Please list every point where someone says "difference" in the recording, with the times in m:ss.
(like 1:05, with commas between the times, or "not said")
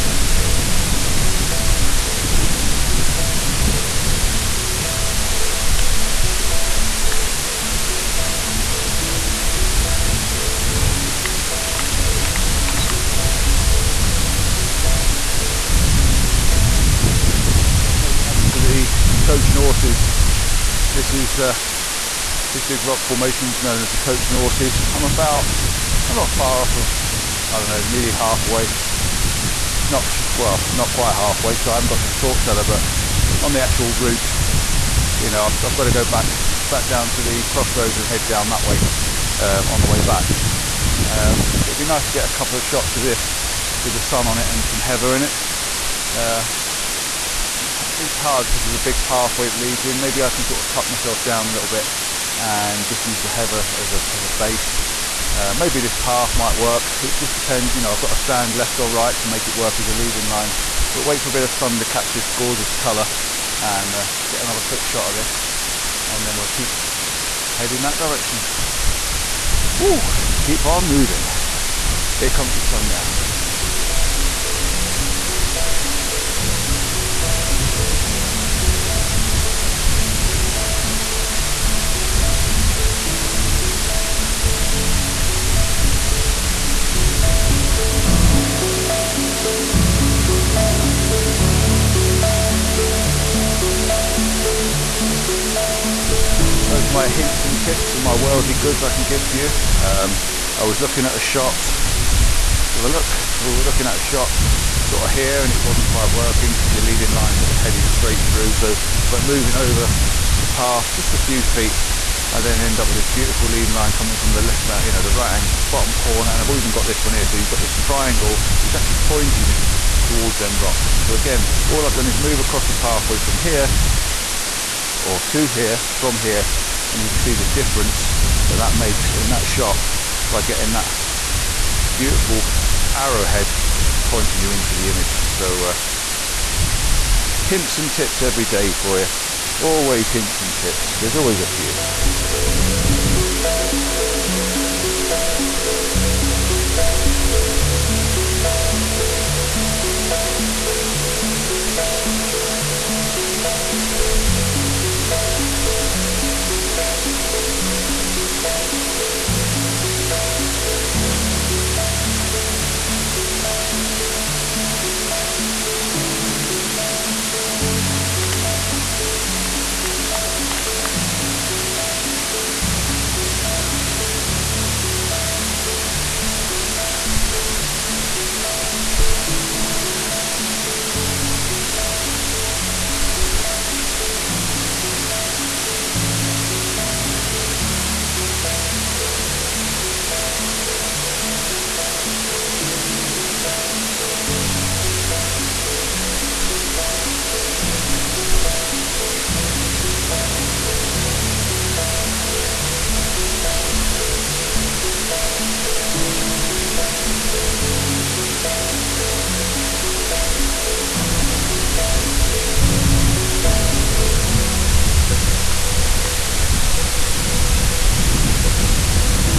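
2:07.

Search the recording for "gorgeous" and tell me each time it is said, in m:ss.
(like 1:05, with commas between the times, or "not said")
1:02.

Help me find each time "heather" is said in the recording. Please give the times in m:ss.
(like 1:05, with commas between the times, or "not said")
0:44, 0:53.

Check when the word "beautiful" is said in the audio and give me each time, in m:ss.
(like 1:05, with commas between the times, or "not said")
1:53, 2:11.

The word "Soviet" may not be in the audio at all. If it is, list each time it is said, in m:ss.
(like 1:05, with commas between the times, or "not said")
not said.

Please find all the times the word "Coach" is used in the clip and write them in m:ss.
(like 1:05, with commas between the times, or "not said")
0:19, 0:23.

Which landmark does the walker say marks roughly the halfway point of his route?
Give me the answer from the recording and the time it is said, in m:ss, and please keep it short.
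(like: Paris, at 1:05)
the salt cellar, at 0:32.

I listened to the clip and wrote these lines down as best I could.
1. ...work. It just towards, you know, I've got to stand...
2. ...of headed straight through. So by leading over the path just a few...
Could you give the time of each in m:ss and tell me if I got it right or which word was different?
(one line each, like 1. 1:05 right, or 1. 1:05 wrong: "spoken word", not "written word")
1. 0:56 wrong: "depends", not "towards"
2. 1:47 wrong: "moving", not "leading".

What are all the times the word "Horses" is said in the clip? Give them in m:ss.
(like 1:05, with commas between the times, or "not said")
0:19, 0:24.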